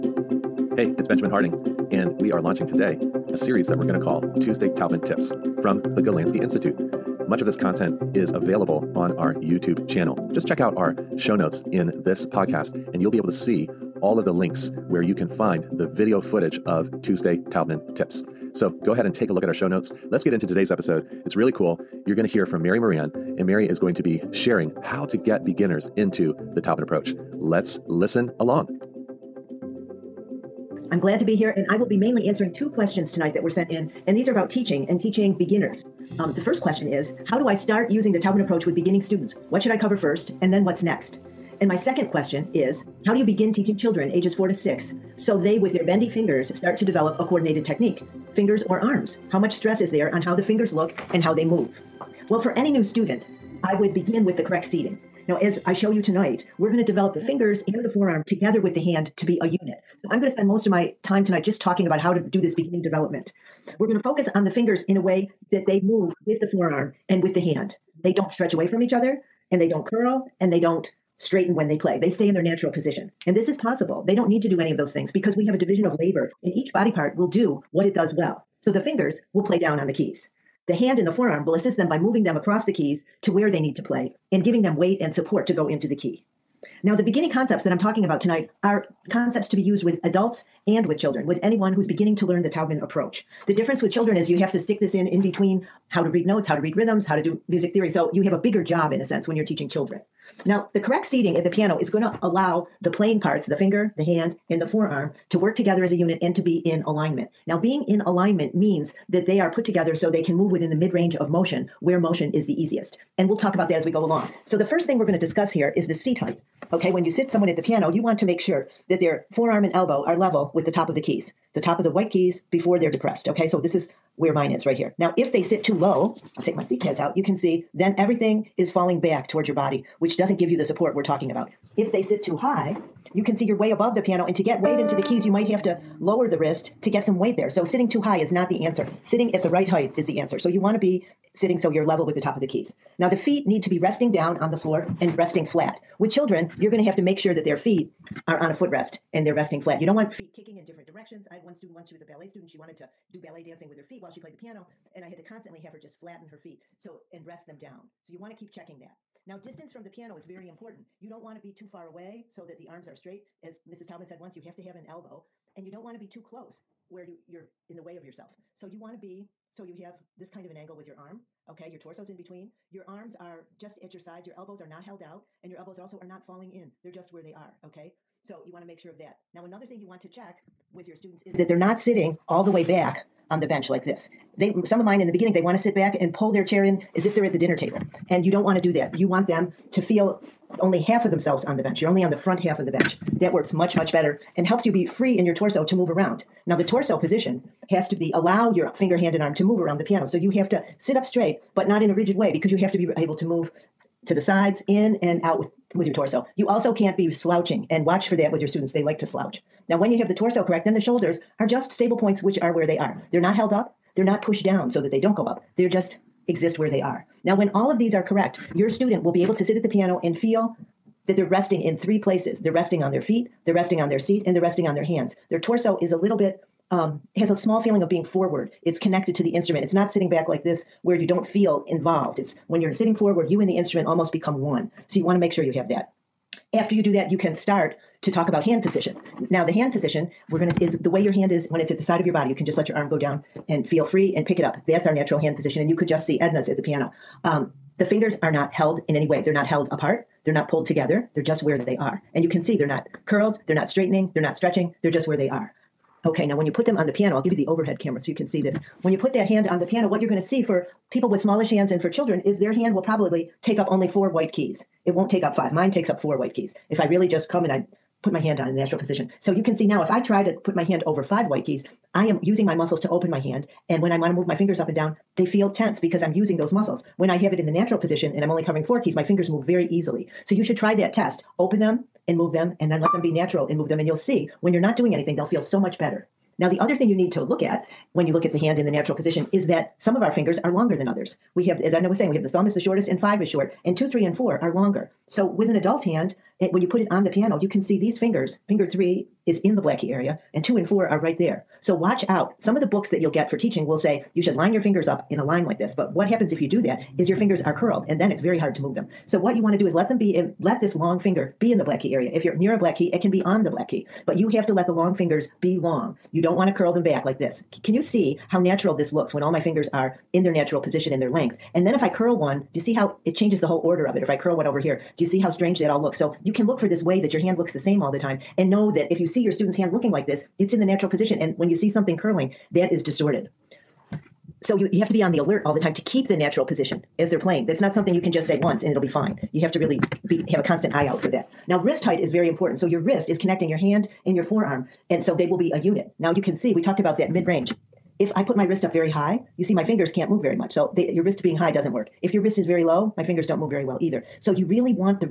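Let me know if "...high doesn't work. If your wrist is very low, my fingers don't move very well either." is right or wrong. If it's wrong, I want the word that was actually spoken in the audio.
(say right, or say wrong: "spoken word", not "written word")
right.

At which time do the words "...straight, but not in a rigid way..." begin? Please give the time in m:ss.
3:21.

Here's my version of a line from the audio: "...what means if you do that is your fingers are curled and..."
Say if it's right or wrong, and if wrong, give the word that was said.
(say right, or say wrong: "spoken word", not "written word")
wrong: "happens", not "means".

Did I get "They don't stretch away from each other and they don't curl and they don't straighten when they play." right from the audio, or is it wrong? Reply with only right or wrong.
right.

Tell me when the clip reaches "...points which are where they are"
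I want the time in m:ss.
3:31.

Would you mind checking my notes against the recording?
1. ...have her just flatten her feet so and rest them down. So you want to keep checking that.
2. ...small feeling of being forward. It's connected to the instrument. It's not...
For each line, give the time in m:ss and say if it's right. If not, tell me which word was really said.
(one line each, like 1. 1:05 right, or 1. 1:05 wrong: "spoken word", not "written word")
1. 2:35 right
2. 3:47 right.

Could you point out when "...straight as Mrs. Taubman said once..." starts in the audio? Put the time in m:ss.
2:42.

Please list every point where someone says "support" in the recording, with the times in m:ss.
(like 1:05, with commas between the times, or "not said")
1:25, 2:10.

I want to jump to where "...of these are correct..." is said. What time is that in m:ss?
3:37.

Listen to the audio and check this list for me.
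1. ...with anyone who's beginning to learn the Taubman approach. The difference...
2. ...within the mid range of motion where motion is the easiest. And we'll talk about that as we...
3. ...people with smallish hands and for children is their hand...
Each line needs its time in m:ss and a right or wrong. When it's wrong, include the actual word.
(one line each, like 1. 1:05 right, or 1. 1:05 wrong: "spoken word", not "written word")
1. 1:31 right
2. 1:50 right
3. 4:20 right.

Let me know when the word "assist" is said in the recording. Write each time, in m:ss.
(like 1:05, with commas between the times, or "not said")
1:21.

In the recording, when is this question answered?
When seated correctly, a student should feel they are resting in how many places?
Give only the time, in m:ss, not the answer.
3:41.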